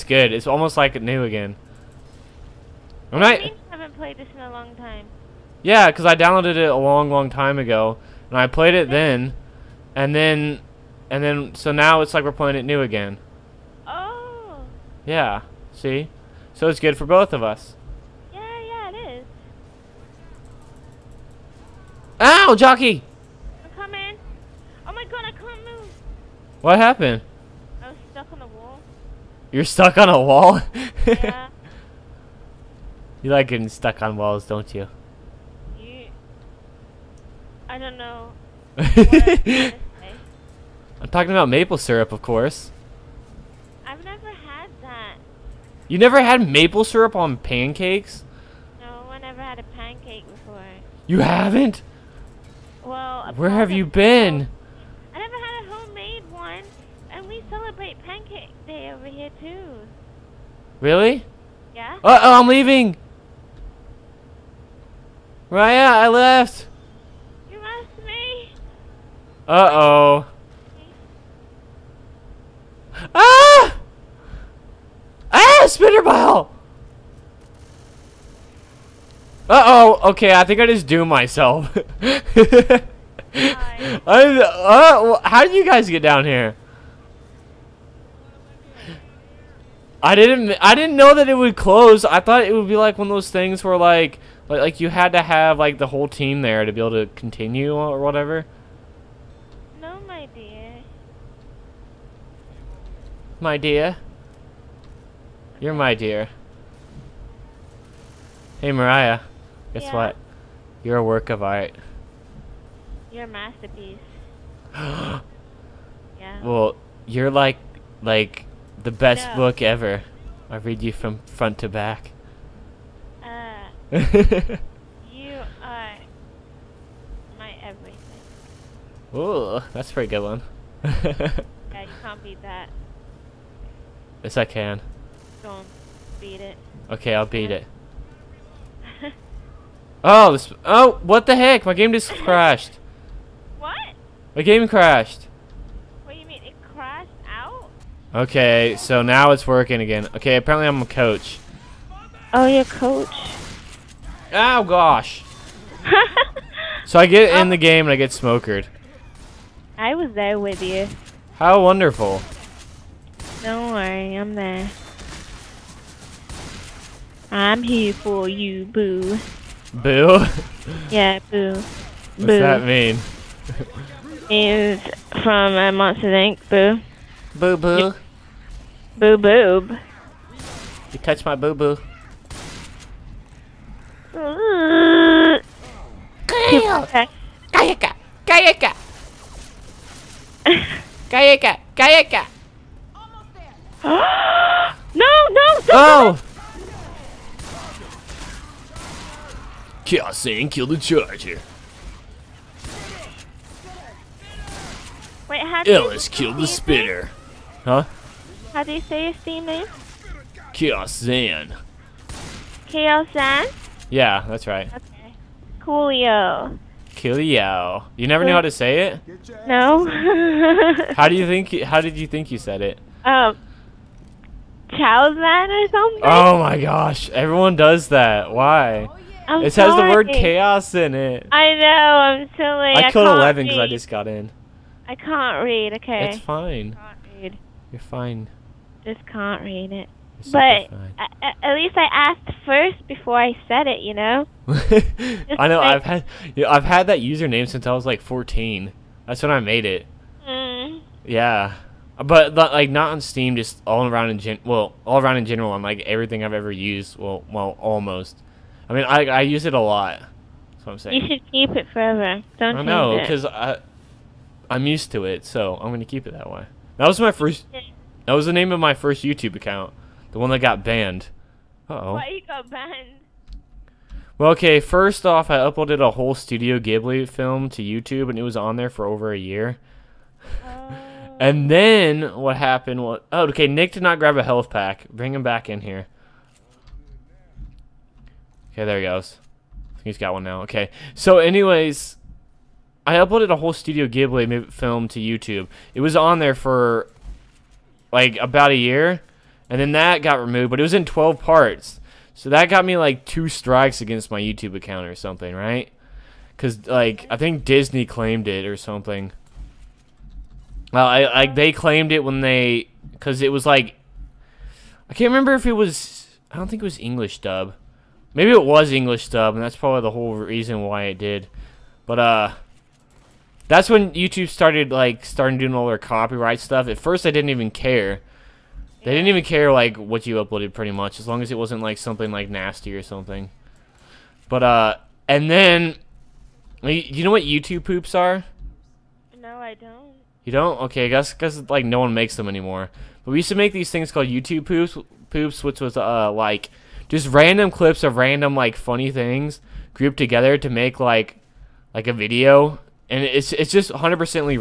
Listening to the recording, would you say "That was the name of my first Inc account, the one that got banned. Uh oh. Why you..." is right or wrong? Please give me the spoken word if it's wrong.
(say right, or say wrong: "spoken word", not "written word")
wrong: "YouTube", not "Inc".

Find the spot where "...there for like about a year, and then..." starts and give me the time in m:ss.
4:56.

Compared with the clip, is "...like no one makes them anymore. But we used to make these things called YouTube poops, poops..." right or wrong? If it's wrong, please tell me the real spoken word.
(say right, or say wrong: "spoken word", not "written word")
right.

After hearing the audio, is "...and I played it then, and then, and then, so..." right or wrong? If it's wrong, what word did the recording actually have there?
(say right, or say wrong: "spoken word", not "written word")
right.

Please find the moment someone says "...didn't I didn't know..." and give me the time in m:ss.
1:30.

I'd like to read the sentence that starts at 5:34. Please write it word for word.
But uh, and then, you know what YouTube poops are?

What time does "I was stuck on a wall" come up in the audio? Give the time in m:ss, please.
0:27.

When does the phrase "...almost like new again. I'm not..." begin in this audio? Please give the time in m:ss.
0:00.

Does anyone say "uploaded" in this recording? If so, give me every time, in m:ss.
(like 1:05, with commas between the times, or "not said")
4:35, 4:52, 5:30.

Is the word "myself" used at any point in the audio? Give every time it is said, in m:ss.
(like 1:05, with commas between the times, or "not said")
1:21.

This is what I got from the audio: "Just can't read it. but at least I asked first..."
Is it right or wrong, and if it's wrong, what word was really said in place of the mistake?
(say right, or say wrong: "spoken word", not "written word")
right.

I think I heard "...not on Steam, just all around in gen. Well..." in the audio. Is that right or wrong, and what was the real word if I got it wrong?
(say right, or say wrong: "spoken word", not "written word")
right.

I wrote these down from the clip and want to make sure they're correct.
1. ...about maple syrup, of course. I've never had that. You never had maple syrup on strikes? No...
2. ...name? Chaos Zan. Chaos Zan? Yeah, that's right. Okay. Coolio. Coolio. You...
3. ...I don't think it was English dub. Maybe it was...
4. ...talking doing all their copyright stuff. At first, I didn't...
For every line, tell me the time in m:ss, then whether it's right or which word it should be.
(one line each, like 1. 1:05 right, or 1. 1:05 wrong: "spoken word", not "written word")
1. 0:41 wrong: "pancakes", not "strikes"
2. 3:29 right
3. 5:16 right
4. 5:25 wrong: "starting", not "talking".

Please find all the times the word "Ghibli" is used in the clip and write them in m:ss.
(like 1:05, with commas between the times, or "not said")
4:36, 4:53.